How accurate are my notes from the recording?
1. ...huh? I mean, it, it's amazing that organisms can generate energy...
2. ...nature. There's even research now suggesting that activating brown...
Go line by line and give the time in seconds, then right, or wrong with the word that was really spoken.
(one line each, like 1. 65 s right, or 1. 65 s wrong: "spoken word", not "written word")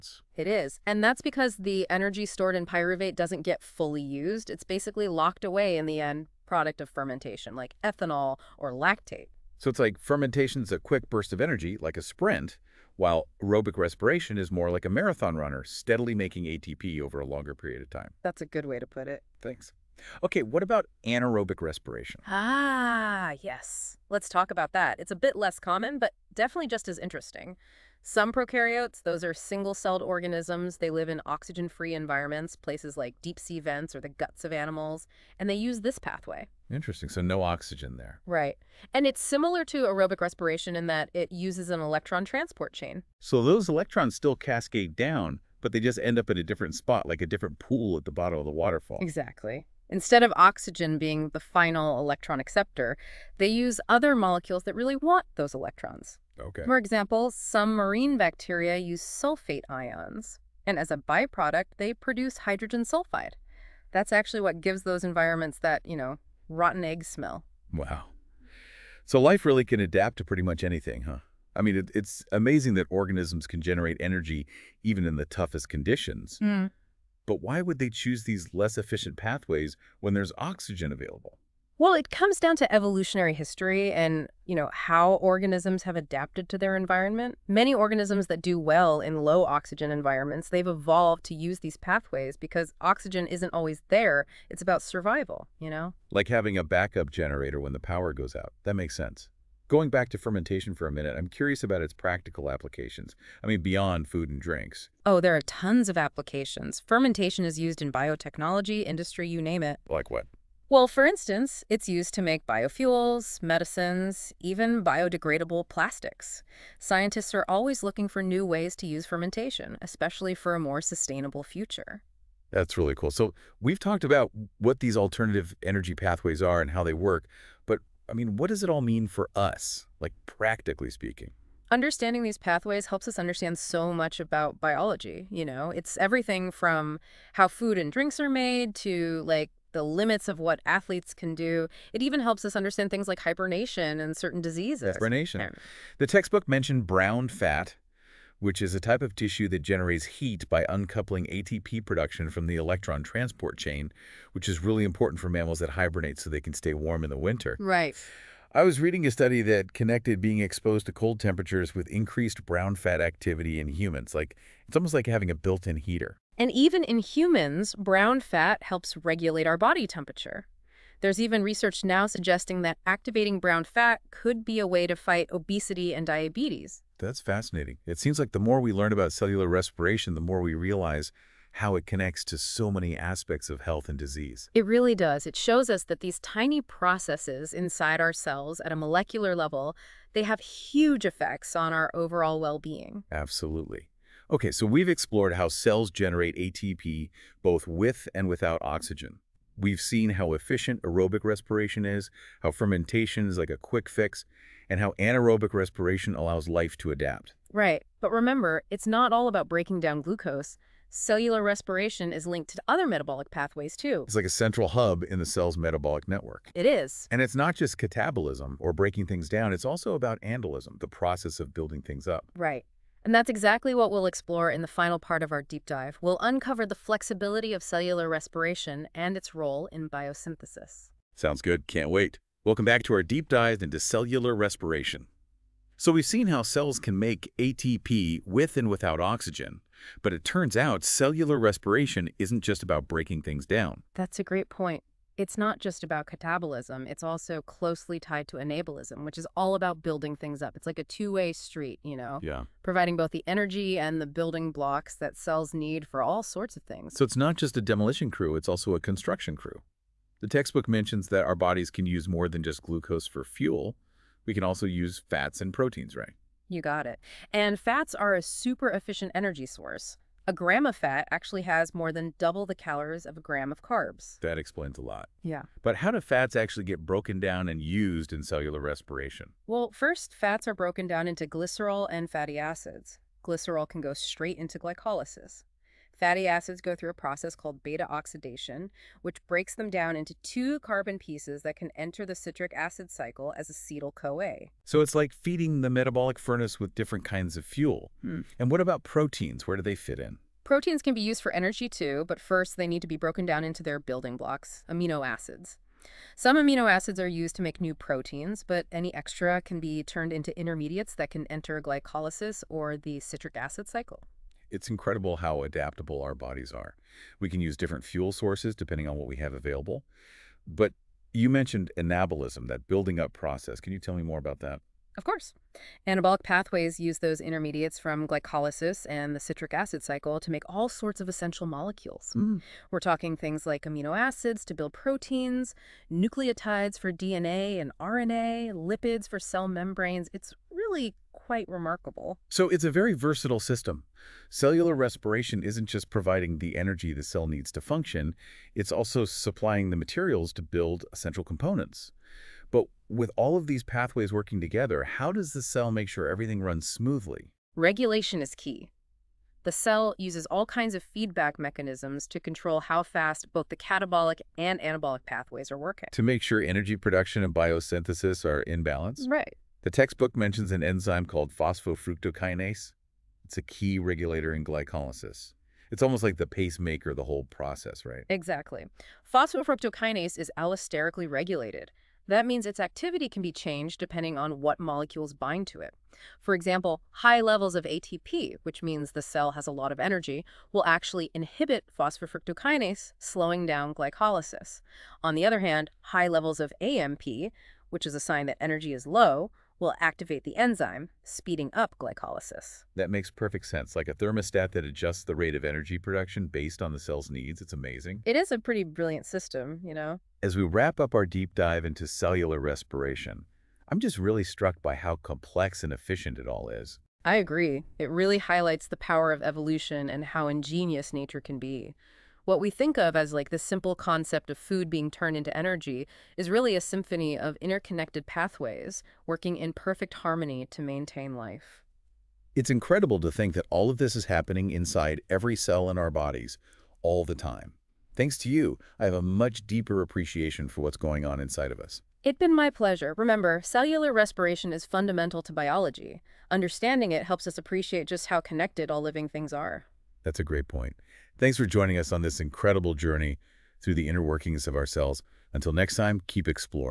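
1. 71 s right
2. 169 s wrong: "temperature", not "nature".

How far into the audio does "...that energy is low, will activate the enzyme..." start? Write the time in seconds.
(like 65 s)
398 s.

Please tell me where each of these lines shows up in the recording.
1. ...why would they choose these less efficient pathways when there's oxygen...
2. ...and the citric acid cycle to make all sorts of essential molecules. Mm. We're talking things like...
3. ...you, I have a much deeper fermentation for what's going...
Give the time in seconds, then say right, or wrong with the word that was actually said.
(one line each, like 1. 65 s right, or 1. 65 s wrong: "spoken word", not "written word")
1. 77 s right
2. 328 s right
3. 438 s wrong: "appreciation", not "fermentation".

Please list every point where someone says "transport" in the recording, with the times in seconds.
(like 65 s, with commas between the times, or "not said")
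42 s, 153 s.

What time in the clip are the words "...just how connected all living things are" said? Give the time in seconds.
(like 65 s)
447 s.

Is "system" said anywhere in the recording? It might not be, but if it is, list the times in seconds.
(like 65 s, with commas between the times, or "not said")
343 s, 409 s.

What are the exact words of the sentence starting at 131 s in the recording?
Understanding these pathways helps us understand so much about biology, you know?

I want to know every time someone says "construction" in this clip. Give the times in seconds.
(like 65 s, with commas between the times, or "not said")
258 s.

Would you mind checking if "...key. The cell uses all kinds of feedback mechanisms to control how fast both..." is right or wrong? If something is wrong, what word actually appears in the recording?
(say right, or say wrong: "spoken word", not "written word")
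right.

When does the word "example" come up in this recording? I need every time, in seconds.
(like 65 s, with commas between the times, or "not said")
56 s, 386 s.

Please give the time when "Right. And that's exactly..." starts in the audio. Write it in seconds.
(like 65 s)
222 s.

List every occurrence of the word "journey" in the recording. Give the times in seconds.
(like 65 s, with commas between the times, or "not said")
452 s.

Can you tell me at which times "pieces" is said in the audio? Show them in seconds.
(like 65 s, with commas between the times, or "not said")
290 s.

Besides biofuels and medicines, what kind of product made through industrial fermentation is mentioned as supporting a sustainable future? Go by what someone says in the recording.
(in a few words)
Biodegradable plastics.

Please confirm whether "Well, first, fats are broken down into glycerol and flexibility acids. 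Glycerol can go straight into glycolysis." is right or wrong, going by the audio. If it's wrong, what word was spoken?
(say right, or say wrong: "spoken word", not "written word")
wrong: "fatty", not "flexibility".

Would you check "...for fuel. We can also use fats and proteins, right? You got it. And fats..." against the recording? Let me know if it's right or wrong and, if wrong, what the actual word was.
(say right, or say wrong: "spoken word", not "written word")
right.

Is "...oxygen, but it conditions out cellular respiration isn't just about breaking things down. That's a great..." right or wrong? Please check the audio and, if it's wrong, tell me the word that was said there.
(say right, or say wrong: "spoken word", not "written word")
wrong: "turns", not "conditions".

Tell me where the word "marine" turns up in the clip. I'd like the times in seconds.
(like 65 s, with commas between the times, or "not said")
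57 s.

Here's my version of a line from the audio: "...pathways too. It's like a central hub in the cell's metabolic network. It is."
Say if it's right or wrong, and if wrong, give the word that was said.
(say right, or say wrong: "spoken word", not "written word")
right.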